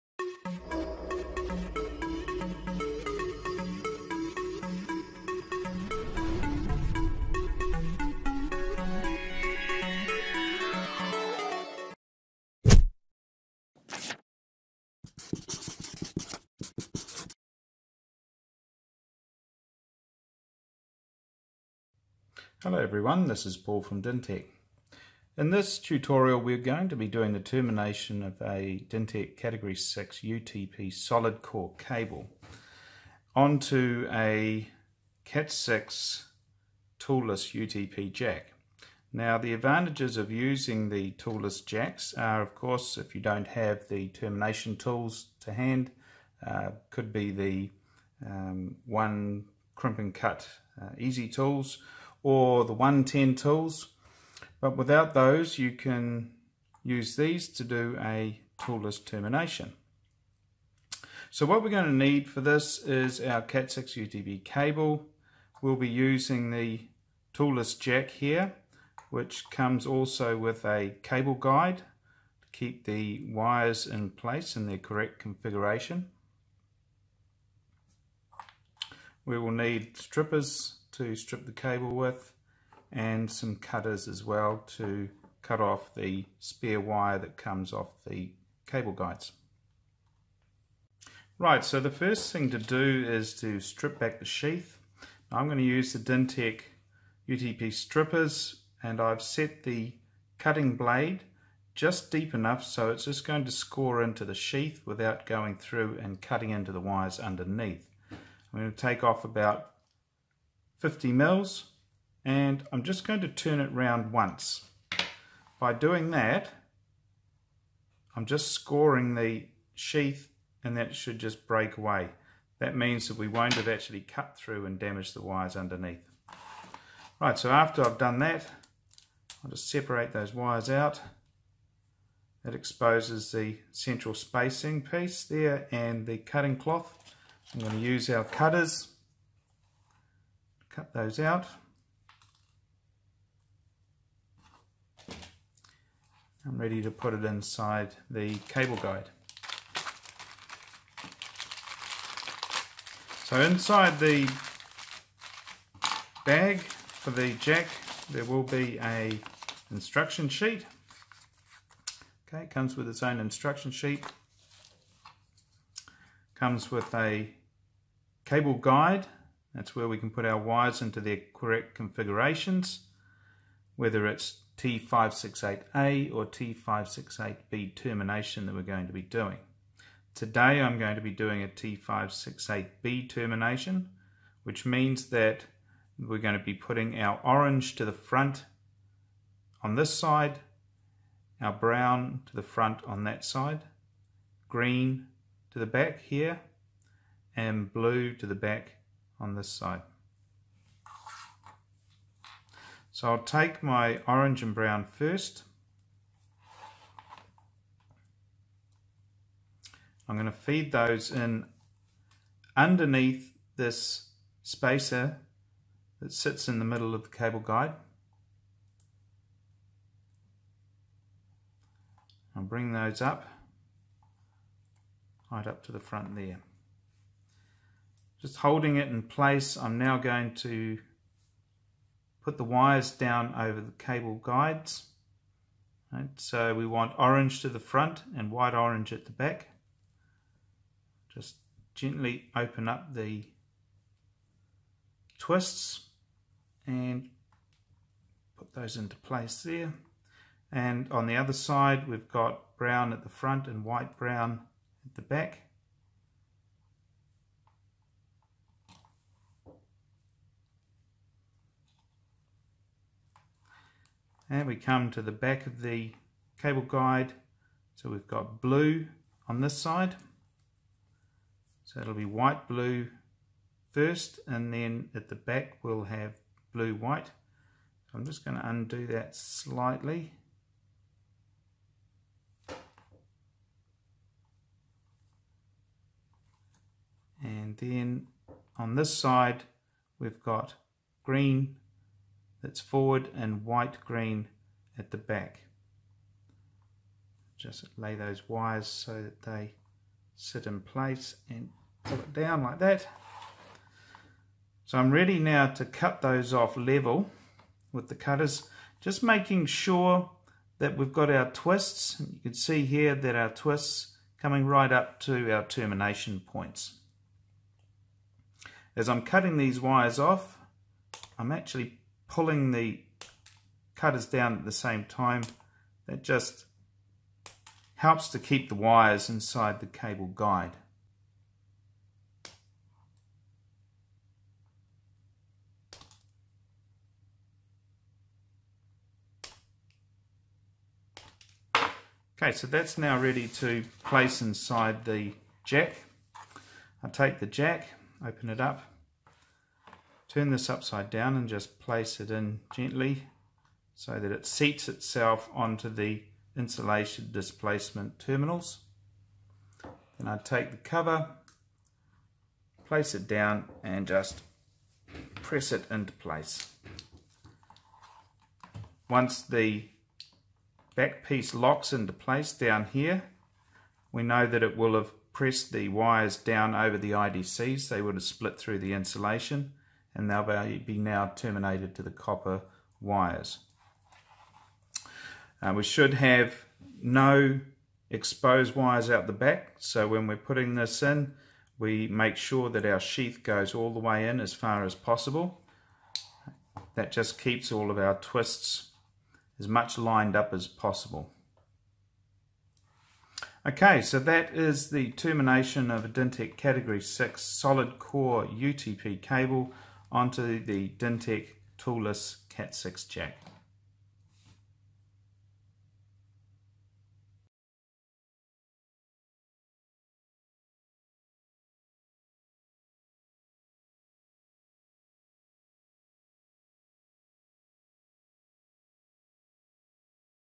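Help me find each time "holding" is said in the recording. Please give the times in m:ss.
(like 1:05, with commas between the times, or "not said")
3:48.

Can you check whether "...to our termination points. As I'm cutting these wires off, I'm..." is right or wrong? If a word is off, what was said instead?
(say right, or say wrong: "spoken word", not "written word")
right.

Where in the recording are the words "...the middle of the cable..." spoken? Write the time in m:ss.
3:36.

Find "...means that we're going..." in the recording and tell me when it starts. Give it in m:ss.
3:04.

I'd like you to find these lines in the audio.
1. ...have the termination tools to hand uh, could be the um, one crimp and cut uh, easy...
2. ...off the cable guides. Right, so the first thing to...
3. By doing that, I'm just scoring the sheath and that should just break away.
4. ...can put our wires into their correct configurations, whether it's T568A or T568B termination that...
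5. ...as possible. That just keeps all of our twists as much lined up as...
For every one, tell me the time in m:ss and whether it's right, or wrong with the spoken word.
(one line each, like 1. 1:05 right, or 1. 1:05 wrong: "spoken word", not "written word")
1. 0:43 right
2. 1:27 right
3. 1:55 right
4. 2:49 right
5. 6:34 right.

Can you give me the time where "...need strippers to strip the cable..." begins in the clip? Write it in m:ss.
1:19.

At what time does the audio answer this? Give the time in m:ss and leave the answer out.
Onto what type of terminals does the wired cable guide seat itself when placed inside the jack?
5:56.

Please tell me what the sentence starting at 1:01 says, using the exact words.
So what we're going to need for this is our Cat6 UTP cable.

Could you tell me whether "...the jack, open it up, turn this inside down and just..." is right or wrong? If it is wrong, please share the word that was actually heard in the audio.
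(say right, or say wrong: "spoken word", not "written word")
wrong: "upside", not "inside".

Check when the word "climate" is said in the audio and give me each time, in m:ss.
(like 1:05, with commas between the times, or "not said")
not said.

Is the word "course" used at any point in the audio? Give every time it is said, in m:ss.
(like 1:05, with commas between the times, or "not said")
0:42.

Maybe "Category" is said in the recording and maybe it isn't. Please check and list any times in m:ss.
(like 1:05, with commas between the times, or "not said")
0:29, 6:46.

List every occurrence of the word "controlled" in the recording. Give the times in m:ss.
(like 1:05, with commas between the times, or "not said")
not said.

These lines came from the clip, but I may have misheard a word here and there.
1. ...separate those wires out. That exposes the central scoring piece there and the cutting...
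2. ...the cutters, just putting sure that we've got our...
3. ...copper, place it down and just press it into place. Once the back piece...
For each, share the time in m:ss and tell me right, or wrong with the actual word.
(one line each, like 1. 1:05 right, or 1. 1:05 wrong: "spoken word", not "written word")
1. 2:09 wrong: "spacing", not "scoring"
2. 5:07 wrong: "making", not "putting"
3. 6:00 wrong: "cover", not "copper".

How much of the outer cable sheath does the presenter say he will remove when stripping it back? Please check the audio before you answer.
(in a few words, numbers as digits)
50 mils.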